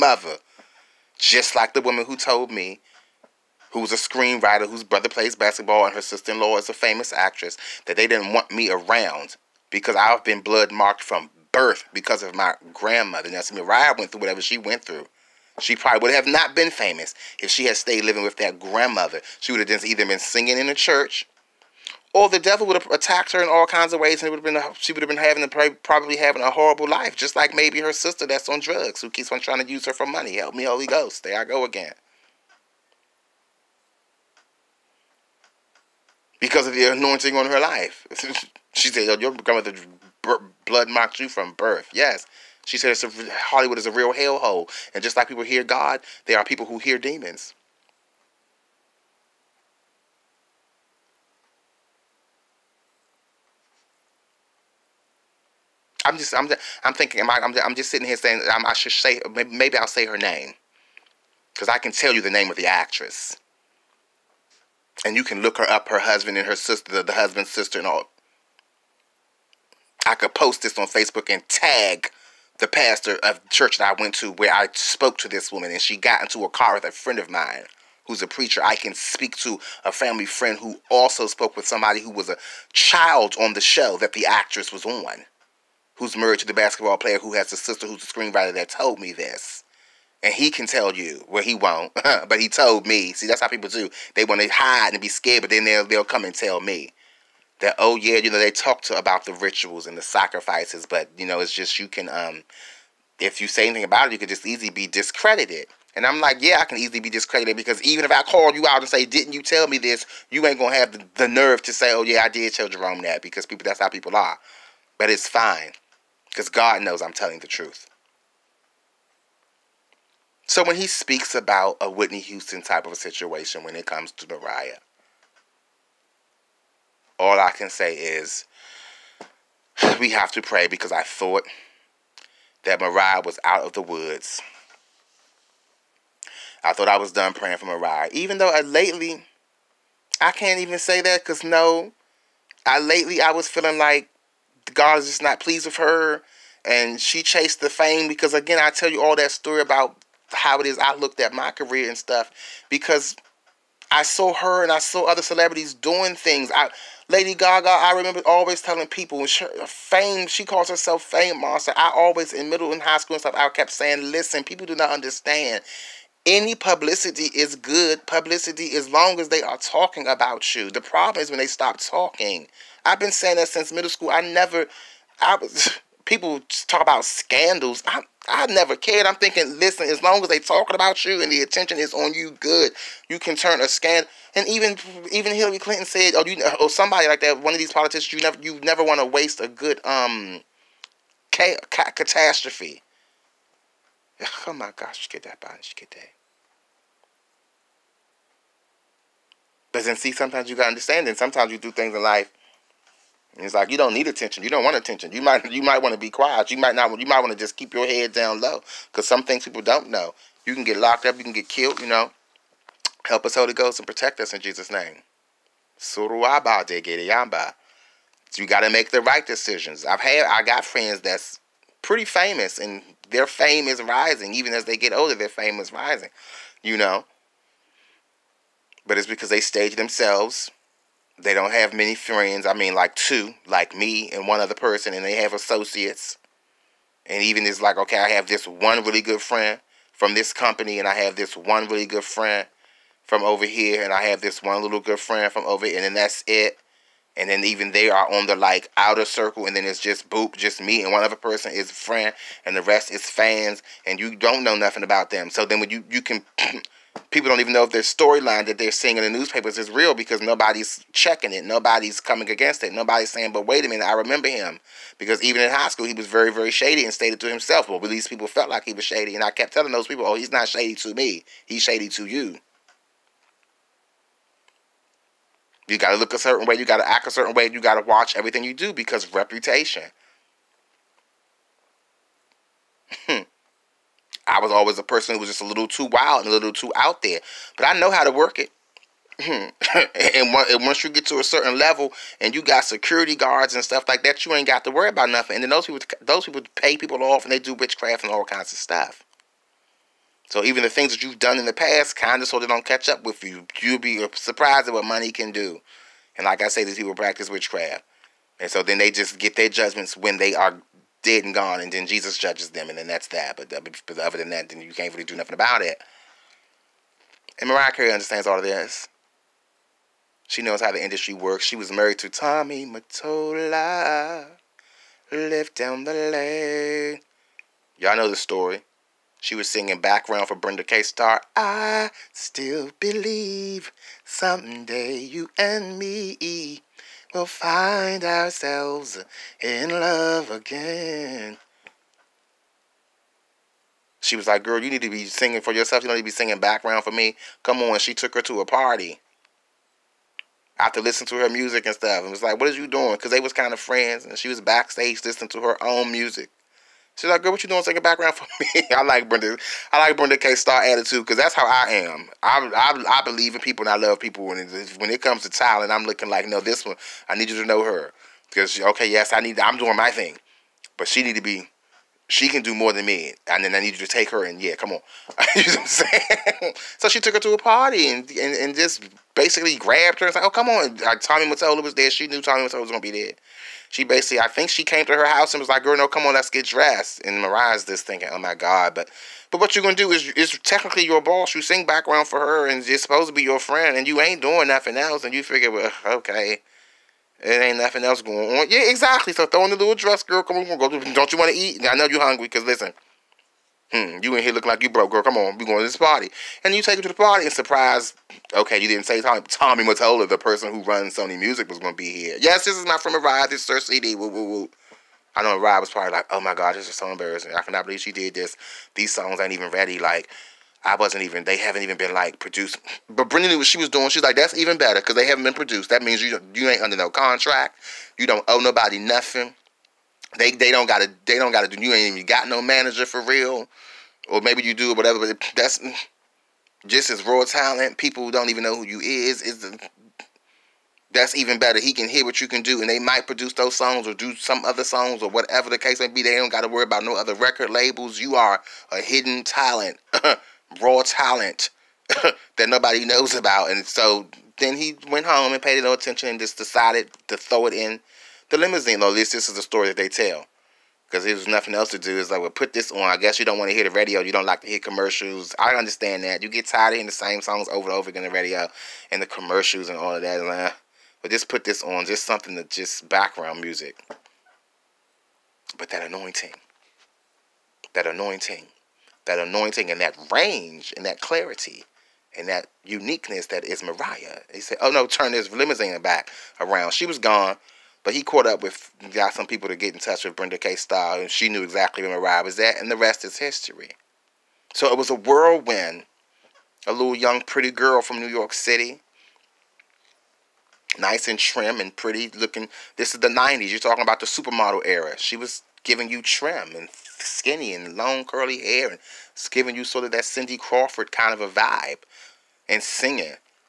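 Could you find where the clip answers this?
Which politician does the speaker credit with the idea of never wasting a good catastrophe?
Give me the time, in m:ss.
3:05.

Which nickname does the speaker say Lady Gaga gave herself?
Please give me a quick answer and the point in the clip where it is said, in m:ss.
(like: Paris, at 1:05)
fame monster, at 2:41.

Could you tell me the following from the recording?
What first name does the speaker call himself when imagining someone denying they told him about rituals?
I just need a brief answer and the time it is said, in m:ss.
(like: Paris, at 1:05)
Jerome, at 1:52.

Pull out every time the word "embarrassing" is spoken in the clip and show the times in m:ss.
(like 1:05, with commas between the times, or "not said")
6:56.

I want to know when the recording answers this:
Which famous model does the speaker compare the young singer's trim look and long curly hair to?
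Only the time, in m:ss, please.
8:30.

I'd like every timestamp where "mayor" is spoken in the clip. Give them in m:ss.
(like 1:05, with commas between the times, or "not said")
not said.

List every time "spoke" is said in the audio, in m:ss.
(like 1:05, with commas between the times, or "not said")
1:14, 1:21.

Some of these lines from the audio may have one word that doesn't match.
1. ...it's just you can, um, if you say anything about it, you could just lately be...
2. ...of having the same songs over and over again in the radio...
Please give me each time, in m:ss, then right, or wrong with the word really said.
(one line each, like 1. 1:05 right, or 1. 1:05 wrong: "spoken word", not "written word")
1. 1:41 wrong: "easily", not "lately"
2. 7:46 wrong: "hearing", not "having".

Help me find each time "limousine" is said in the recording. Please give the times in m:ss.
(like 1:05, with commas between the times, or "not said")
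7:38, 8:05.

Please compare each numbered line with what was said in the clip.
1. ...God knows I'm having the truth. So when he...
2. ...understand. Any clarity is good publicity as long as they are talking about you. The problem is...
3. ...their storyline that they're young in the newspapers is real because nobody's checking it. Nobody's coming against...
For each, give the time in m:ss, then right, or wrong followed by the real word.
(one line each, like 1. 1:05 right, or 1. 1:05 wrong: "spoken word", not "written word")
1. 1:56 wrong: "telling", not "having"
2. 2:44 wrong: "publicity", not "clarity"
3. 4:17 wrong: "seeing", not "young".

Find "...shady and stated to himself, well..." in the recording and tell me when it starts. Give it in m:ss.
4:26.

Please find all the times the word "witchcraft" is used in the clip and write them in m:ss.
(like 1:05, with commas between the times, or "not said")
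4:57, 5:07.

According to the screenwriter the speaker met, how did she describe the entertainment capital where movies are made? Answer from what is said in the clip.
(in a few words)
a real hellhole.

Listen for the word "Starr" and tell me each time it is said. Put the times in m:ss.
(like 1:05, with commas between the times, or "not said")
5:30, 6:00, 8:10.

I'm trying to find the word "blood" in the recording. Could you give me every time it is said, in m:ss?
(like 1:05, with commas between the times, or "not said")
0:10, 0:40.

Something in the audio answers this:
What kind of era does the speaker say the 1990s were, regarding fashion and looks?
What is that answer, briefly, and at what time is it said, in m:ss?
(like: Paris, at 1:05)
the supermodel era, at 8:24.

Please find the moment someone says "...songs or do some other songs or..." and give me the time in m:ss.
7:23.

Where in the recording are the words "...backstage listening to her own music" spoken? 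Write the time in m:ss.
5:54.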